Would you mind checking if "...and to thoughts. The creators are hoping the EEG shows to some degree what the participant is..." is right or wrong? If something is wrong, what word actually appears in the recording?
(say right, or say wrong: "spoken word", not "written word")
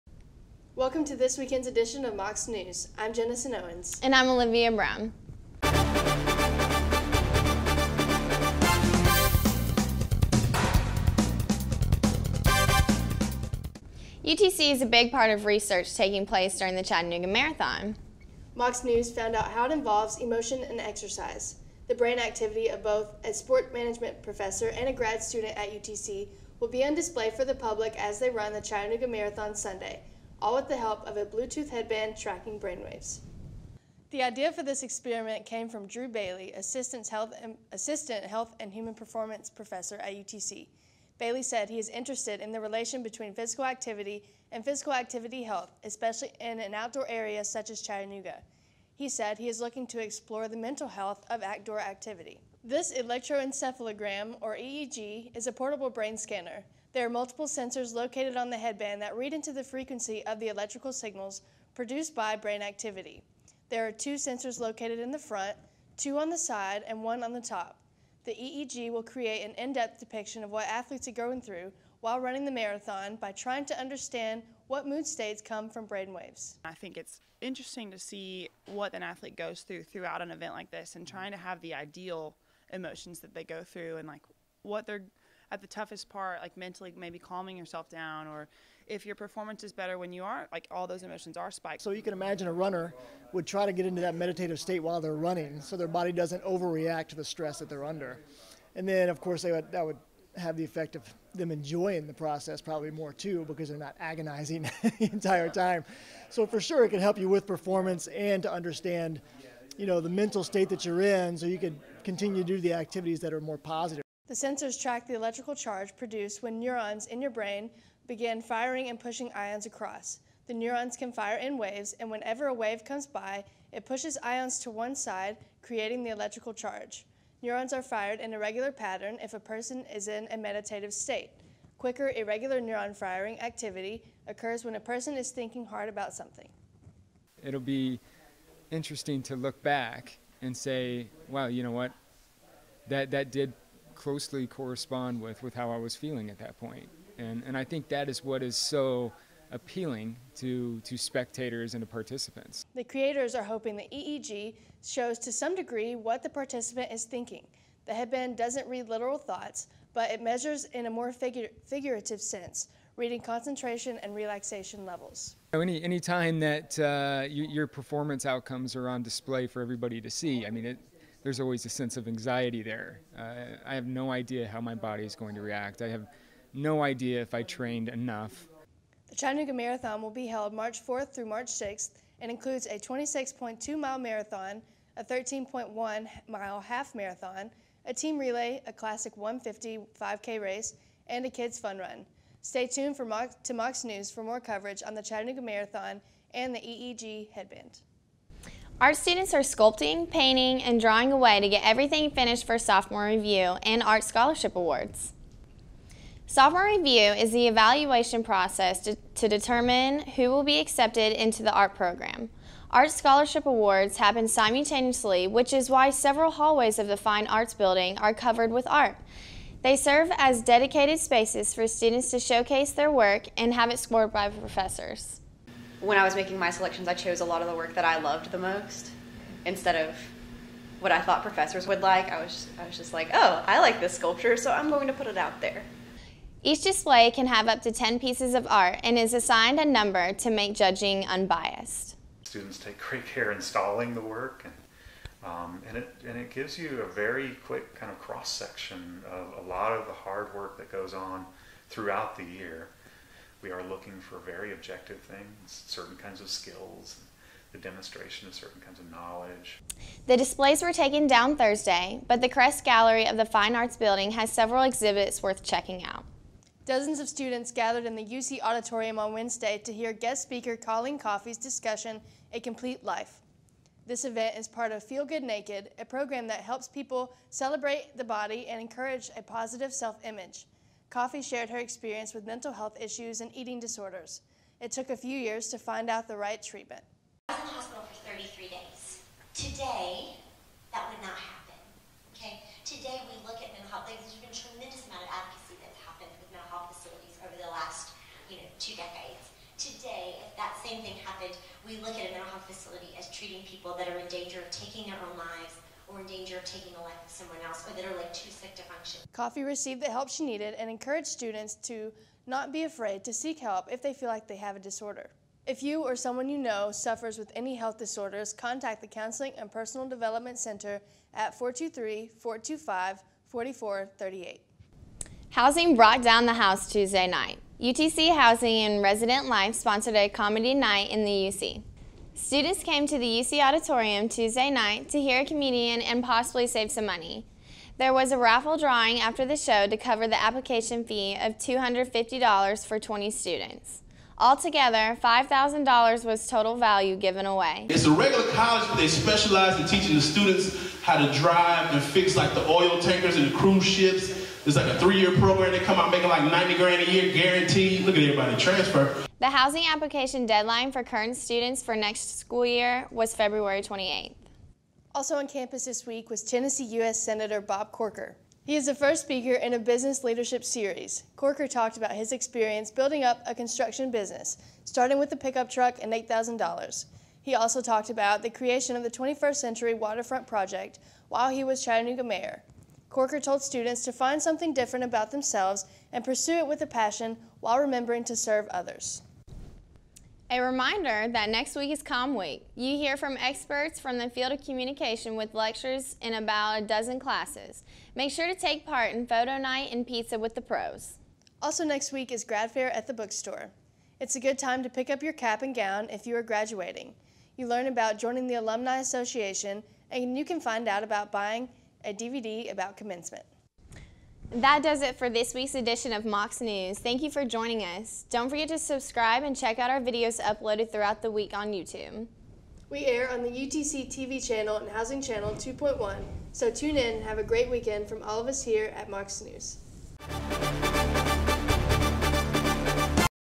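wrong: "participants", not "thoughts".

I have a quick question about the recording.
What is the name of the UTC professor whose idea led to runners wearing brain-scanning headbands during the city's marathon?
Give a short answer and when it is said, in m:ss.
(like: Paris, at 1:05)
Drew Bailey, at 0:35.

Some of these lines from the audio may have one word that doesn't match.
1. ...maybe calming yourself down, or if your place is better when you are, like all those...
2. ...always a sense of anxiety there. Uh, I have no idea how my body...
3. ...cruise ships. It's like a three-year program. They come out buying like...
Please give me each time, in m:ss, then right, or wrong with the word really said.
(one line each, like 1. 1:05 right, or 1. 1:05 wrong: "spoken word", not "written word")
1. 1:26 wrong: "performance", not "place"
2. 2:51 right
3. 5:53 wrong: "making", not "buying".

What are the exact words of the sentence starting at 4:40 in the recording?
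Coffee shared her experience with mental health issues and eating disorders.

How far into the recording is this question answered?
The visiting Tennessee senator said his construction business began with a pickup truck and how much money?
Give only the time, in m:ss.
6:15.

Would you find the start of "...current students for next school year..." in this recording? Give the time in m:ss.
6:00.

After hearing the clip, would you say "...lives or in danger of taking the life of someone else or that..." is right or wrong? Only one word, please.
right.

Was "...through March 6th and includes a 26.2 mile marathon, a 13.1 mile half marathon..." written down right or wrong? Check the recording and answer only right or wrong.
right.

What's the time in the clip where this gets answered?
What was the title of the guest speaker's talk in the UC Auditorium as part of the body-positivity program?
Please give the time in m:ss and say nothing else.
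4:32.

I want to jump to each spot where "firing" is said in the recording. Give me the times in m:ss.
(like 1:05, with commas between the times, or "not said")
1:58, 2:12.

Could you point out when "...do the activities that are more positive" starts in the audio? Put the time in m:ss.
1:52.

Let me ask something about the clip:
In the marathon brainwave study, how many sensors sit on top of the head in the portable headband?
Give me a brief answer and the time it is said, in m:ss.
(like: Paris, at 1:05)
1, at 1:07.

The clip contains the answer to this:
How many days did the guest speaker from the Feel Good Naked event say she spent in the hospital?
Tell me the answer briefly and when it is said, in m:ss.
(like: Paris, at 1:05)
33, at 4:48.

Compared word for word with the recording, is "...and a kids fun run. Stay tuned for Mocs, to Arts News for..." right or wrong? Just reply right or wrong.
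wrong.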